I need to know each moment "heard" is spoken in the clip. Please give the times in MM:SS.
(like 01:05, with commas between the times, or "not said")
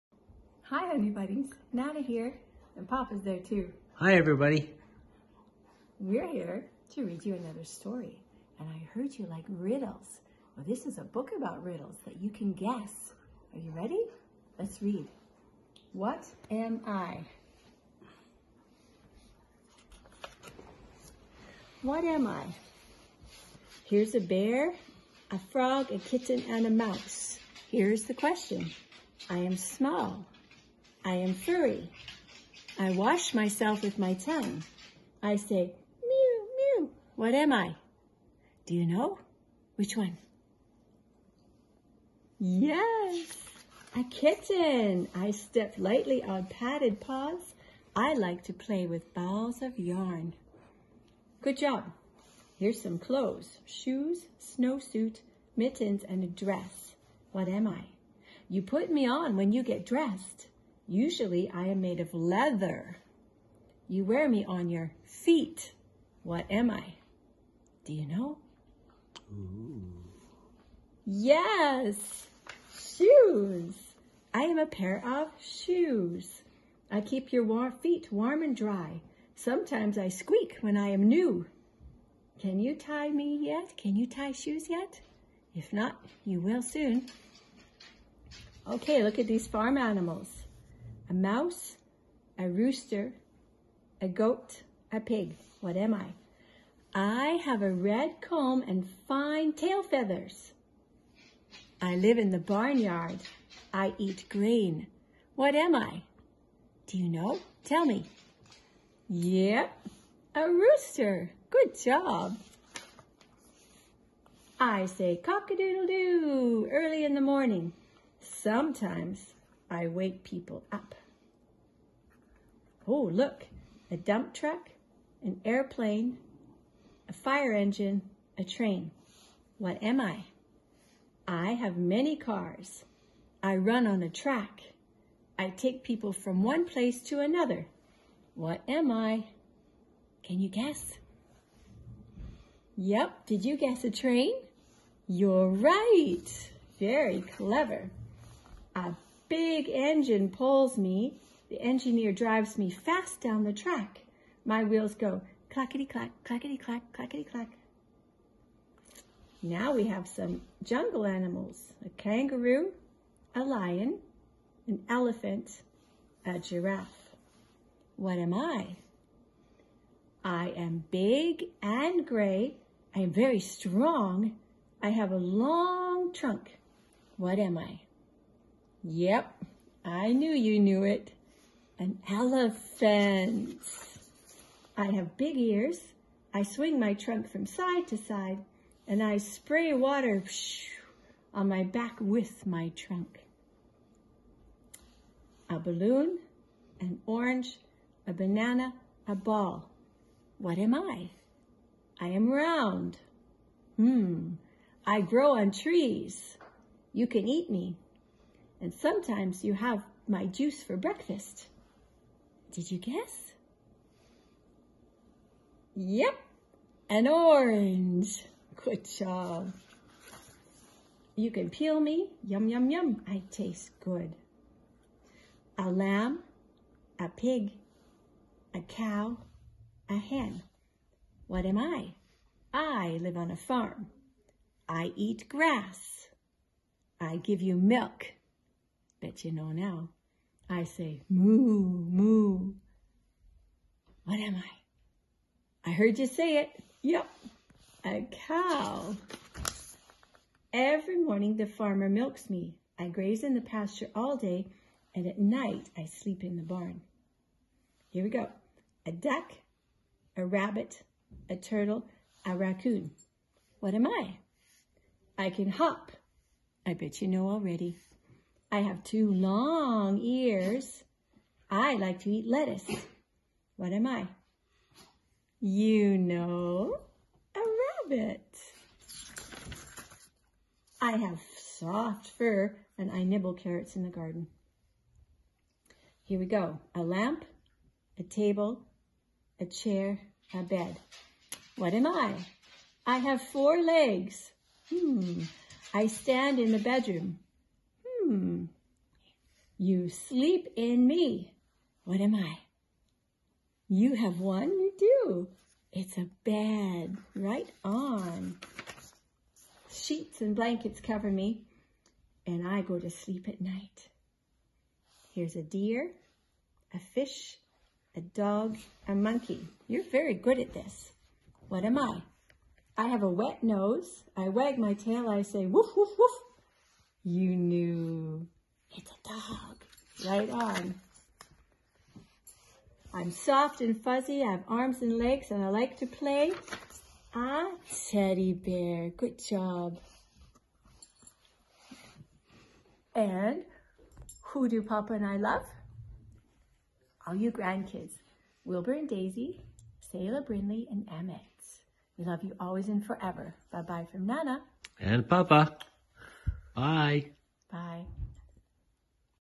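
00:08, 04:05.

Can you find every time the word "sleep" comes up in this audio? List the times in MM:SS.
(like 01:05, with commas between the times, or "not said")
04:15, 04:59, 05:12.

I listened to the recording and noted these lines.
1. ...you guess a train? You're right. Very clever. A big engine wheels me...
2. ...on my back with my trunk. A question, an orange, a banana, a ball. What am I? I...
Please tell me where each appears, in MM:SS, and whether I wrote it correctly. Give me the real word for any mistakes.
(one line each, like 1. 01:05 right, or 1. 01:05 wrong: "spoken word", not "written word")
1. 02:23 wrong: "pulls", not "wheels"
2. 03:11 wrong: "balloon", not "question".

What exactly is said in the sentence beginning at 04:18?
A duck, a rabbit, a turtle, a raccoon.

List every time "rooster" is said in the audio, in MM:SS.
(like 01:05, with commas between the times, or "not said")
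01:32, 01:50.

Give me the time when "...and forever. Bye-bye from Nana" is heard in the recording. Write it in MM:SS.
05:52.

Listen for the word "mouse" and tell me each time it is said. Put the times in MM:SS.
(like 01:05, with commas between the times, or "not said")
00:26, 01:31.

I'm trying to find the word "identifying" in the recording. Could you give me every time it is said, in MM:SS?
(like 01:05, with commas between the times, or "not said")
not said.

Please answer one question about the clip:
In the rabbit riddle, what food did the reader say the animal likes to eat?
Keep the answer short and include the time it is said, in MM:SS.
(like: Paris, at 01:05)
Lettuce, at 04:32.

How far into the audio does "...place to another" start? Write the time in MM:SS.
02:16.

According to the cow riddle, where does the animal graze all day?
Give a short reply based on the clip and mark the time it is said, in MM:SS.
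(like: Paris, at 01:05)
In the pasture, at 04:13.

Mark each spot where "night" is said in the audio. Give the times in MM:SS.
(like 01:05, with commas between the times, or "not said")
04:15, 05:13.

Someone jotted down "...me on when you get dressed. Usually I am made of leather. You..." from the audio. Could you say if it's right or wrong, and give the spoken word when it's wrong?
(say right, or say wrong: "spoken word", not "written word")
right.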